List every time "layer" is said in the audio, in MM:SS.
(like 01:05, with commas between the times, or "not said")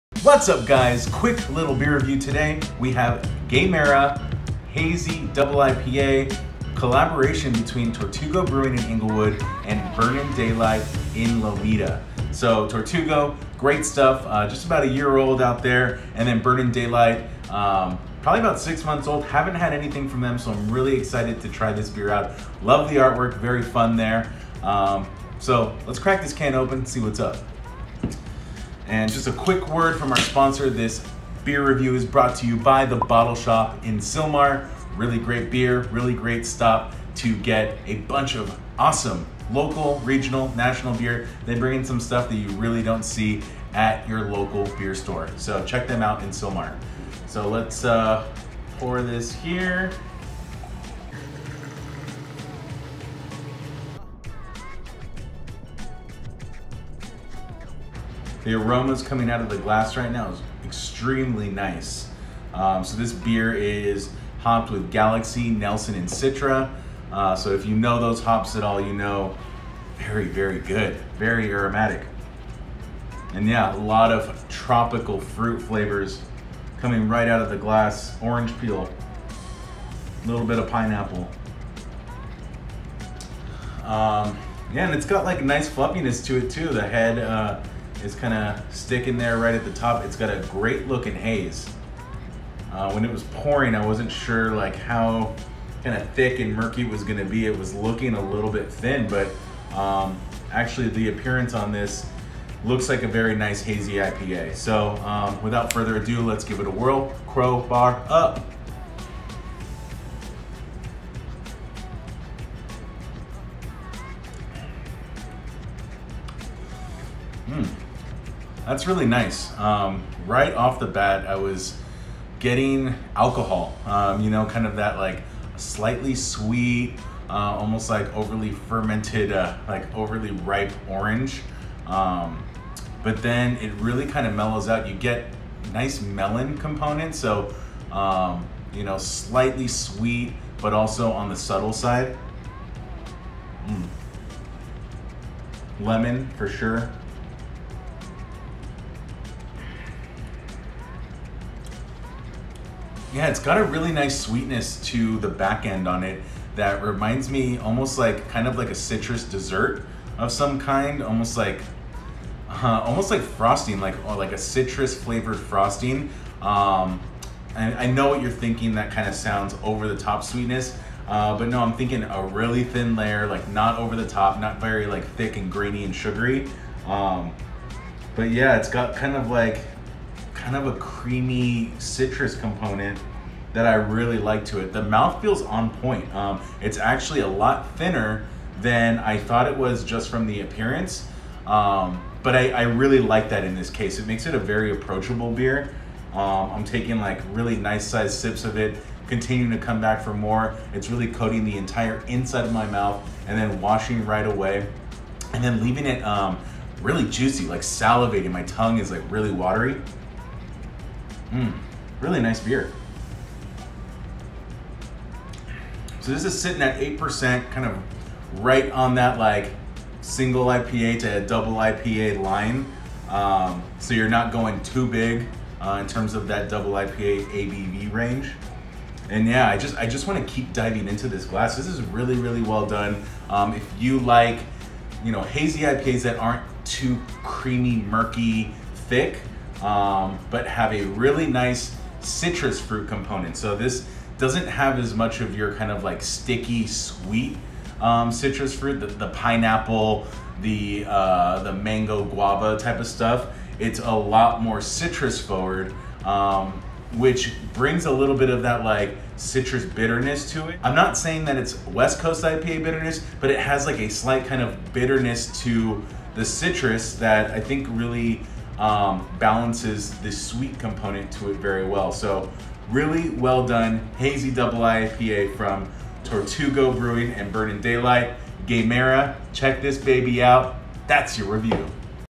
02:52.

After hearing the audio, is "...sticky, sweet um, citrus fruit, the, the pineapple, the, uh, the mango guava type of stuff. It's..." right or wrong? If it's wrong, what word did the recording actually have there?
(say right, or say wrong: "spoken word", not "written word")
right.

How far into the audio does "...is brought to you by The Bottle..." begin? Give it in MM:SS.
00:31.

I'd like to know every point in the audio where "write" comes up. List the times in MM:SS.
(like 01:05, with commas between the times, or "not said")
not said.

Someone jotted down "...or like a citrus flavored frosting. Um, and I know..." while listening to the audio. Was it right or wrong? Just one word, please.
right.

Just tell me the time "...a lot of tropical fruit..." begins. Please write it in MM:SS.
01:13.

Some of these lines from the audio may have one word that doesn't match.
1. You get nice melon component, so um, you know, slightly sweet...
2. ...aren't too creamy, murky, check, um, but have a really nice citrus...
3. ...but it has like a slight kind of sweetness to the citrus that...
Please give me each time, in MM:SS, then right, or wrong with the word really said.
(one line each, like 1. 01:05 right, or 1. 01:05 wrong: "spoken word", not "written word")
1. 02:14 right
2. 03:56 wrong: "thick", not "check"
3. 04:23 wrong: "bitterness", not "sweetness".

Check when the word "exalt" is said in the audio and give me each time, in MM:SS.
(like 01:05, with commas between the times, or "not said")
not said.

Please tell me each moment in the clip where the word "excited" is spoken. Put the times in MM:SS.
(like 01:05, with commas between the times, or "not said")
00:20.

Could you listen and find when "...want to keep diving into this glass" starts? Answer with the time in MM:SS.
03:50.